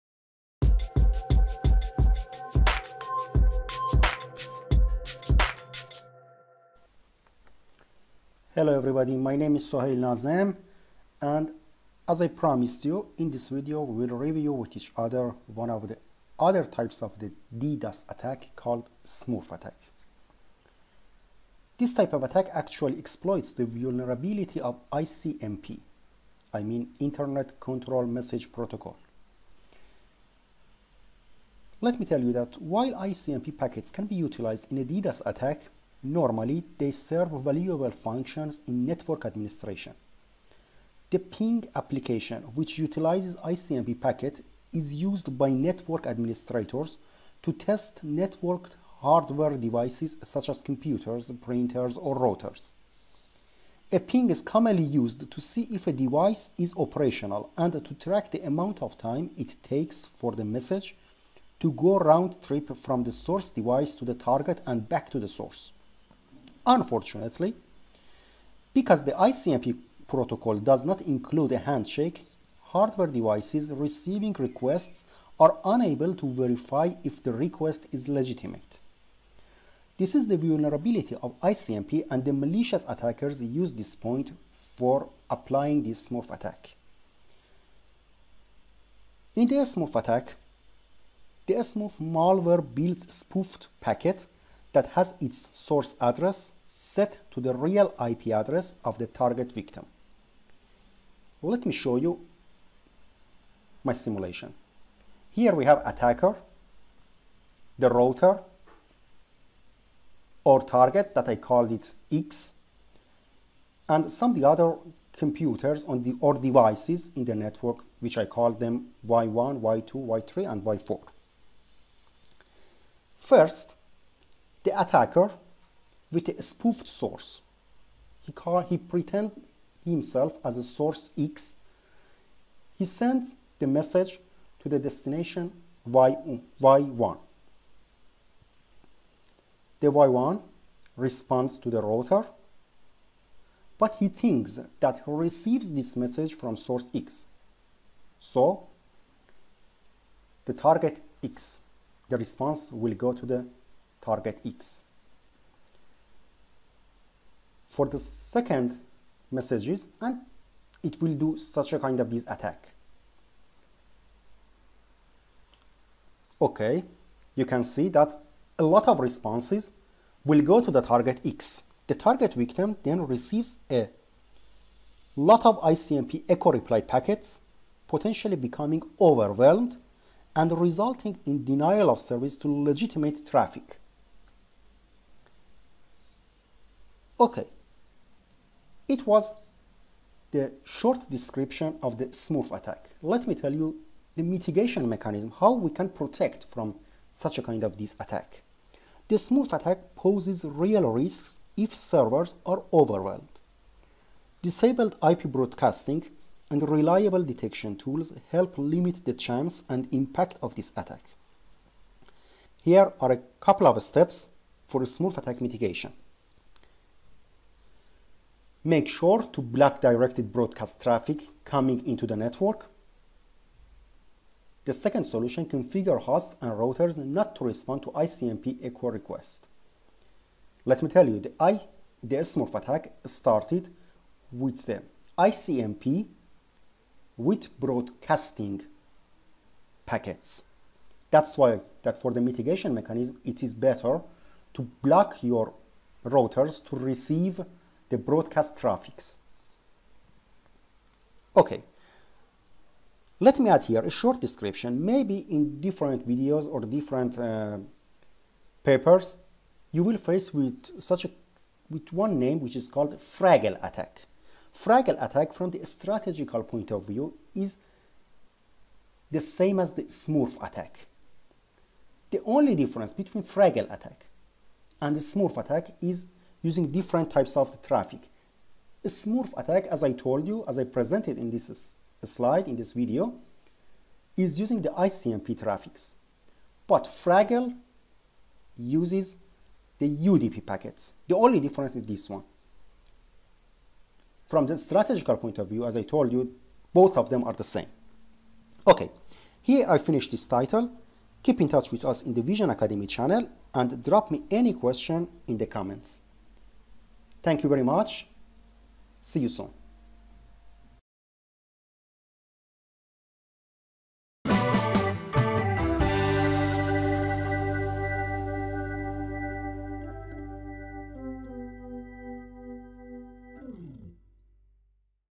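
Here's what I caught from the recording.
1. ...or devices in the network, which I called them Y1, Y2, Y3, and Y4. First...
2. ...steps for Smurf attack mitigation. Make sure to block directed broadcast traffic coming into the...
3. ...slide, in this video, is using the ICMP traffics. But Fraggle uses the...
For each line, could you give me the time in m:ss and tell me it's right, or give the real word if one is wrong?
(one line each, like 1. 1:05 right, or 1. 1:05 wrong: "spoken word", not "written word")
1. 1:56 right
2. 3:33 right
3. 4:42 right.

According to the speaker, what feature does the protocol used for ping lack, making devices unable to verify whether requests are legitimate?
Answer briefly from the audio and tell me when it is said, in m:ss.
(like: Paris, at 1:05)
A handshake, at 1:11.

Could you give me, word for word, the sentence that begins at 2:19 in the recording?
The Y1 responds to the router, but he thinks that he receives this message from source X.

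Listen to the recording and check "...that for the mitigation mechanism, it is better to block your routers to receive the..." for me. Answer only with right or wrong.
right.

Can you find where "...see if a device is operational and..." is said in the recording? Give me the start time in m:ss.
0:55.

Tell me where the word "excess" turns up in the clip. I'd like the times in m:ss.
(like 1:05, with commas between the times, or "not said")
not said.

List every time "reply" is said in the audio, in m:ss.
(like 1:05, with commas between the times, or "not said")
2:56.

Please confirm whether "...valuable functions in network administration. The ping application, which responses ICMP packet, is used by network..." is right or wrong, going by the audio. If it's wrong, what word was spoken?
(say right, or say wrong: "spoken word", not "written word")
wrong: "utilizes", not "responses".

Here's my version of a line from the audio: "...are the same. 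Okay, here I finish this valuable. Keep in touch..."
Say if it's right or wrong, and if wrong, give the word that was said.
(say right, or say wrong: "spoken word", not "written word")
wrong: "title", not "valuable".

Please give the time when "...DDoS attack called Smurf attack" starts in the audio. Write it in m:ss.
0:17.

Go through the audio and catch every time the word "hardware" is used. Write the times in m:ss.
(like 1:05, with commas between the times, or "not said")
0:49, 1:12.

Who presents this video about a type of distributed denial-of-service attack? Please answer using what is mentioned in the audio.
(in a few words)
Sohail Nazem.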